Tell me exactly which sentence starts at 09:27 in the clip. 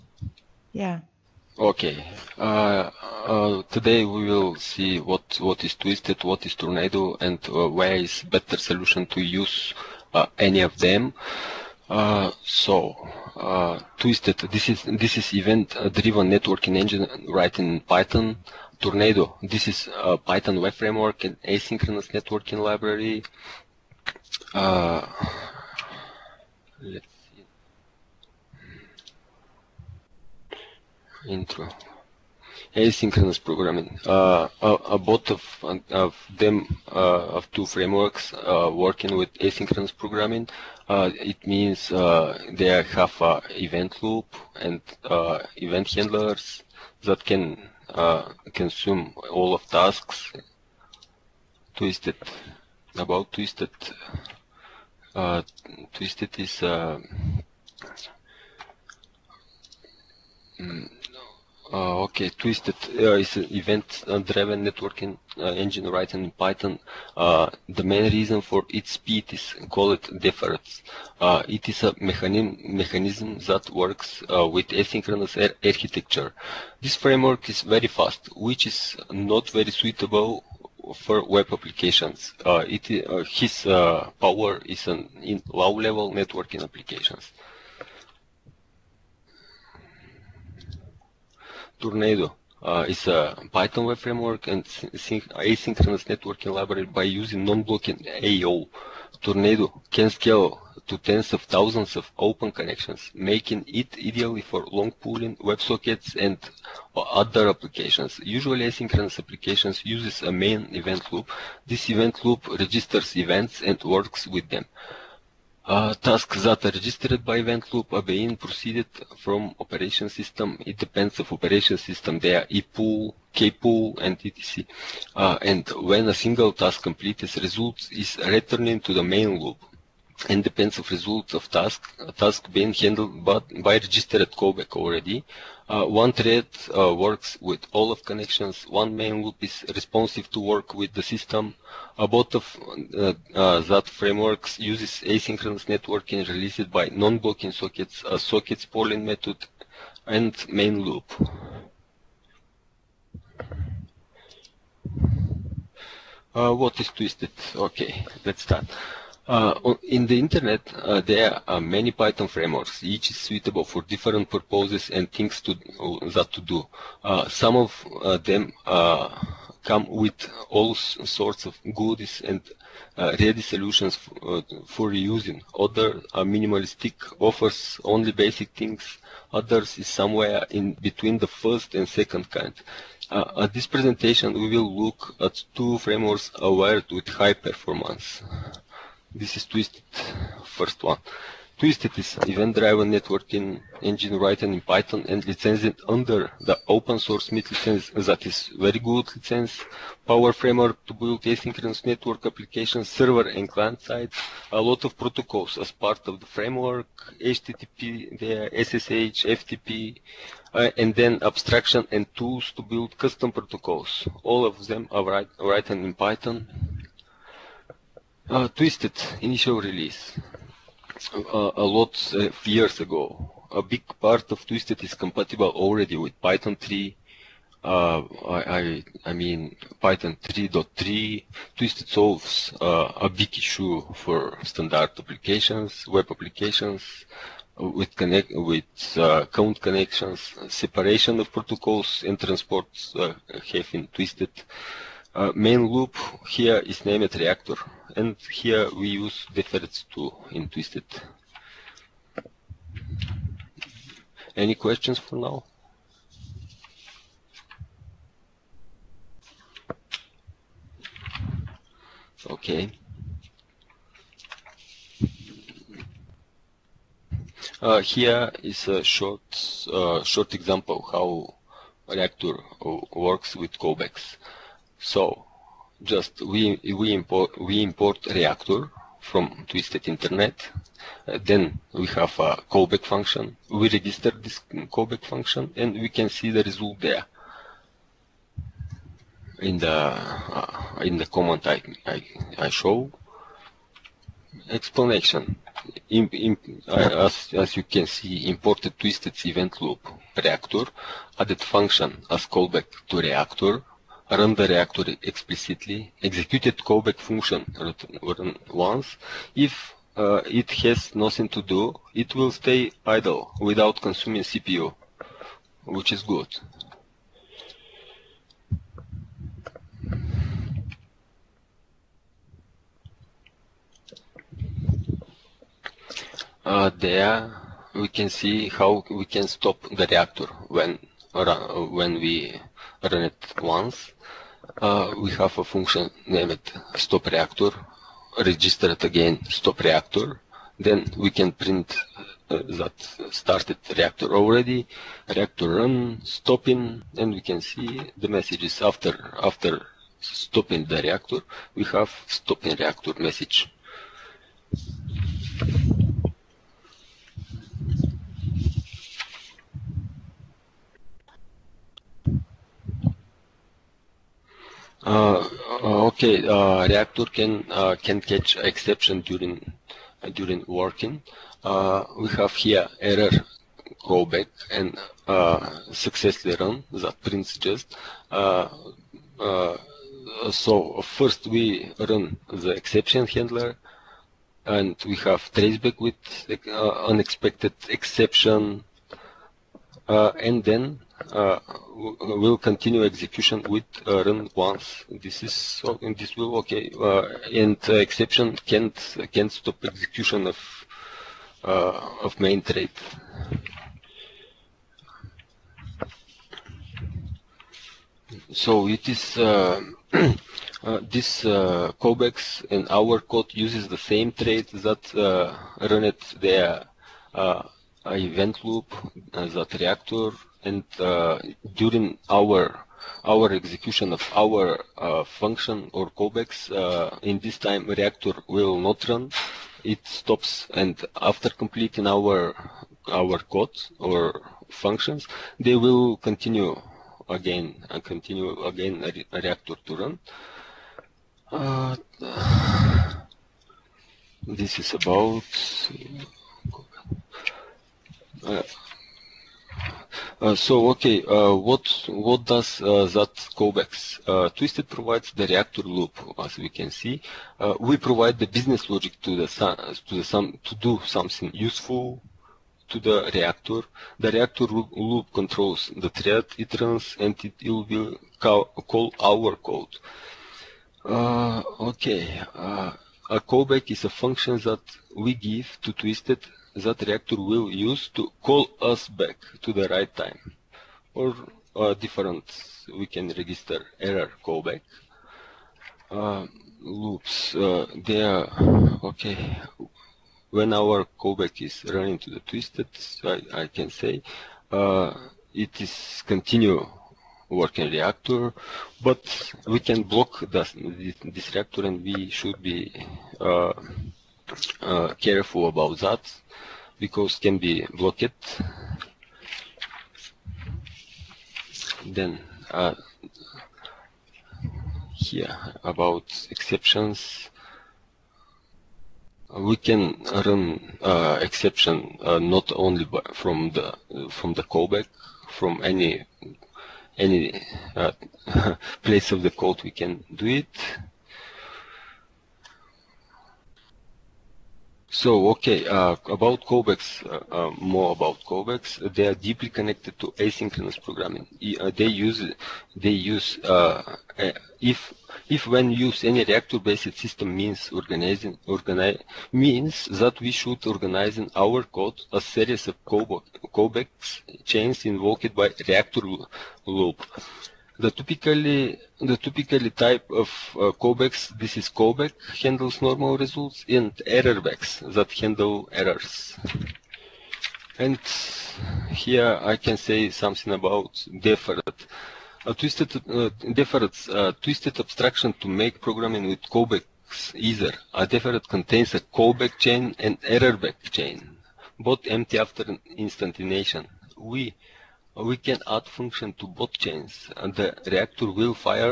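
And here I can say something about deferred.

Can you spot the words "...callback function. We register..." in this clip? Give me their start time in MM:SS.
04:42.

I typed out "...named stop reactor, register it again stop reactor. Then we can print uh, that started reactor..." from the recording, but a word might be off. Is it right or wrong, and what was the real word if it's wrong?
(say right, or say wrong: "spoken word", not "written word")
right.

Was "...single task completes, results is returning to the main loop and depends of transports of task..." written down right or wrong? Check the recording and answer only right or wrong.
wrong.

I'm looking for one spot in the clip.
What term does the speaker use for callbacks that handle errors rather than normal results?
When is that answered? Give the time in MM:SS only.
09:24.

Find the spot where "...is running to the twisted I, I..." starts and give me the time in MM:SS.
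08:11.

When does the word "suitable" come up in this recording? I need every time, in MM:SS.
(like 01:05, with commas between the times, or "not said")
01:19, 02:43.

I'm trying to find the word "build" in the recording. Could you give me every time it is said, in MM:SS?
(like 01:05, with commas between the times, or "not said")
03:20, 03:32.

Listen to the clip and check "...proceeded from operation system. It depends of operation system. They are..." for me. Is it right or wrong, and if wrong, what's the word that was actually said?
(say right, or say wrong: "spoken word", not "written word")
right.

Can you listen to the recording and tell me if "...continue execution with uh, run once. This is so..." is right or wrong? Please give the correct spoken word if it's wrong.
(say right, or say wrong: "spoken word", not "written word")
right.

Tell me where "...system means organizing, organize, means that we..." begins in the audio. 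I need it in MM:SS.
09:06.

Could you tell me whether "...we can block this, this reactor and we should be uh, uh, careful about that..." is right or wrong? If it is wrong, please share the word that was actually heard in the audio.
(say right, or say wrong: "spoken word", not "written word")
right.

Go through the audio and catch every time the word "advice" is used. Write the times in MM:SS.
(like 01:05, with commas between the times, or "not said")
not said.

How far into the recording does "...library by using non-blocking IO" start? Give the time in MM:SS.
01:36.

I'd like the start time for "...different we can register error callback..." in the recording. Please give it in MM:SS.
08:01.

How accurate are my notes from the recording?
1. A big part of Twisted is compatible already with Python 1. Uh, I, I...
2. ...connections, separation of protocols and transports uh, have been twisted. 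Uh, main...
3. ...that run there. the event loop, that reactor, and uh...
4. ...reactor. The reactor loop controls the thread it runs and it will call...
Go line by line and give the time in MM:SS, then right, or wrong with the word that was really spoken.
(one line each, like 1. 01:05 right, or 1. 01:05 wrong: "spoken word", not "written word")
1. 03:43 wrong: "3", not "1"
2. 03:59 right
3. 06:54 right
4. 07:43 right.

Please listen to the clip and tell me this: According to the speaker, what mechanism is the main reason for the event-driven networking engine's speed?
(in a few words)
deferreds.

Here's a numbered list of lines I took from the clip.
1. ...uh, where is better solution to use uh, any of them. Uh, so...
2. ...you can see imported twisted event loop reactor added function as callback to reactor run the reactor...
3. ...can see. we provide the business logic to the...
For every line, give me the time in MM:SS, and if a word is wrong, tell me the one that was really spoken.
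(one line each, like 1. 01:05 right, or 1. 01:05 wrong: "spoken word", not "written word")
1. 00:07 right
2. 04:57 right
3. 07:36 right.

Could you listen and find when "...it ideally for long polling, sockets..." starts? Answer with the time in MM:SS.
01:43.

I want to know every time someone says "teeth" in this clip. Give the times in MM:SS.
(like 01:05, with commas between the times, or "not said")
not said.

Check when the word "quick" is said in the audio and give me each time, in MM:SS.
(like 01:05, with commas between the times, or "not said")
not said.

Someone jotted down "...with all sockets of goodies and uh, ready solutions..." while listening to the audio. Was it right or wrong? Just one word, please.
wrong.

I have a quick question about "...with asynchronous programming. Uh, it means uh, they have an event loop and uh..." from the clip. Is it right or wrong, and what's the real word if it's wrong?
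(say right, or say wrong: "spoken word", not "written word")
right.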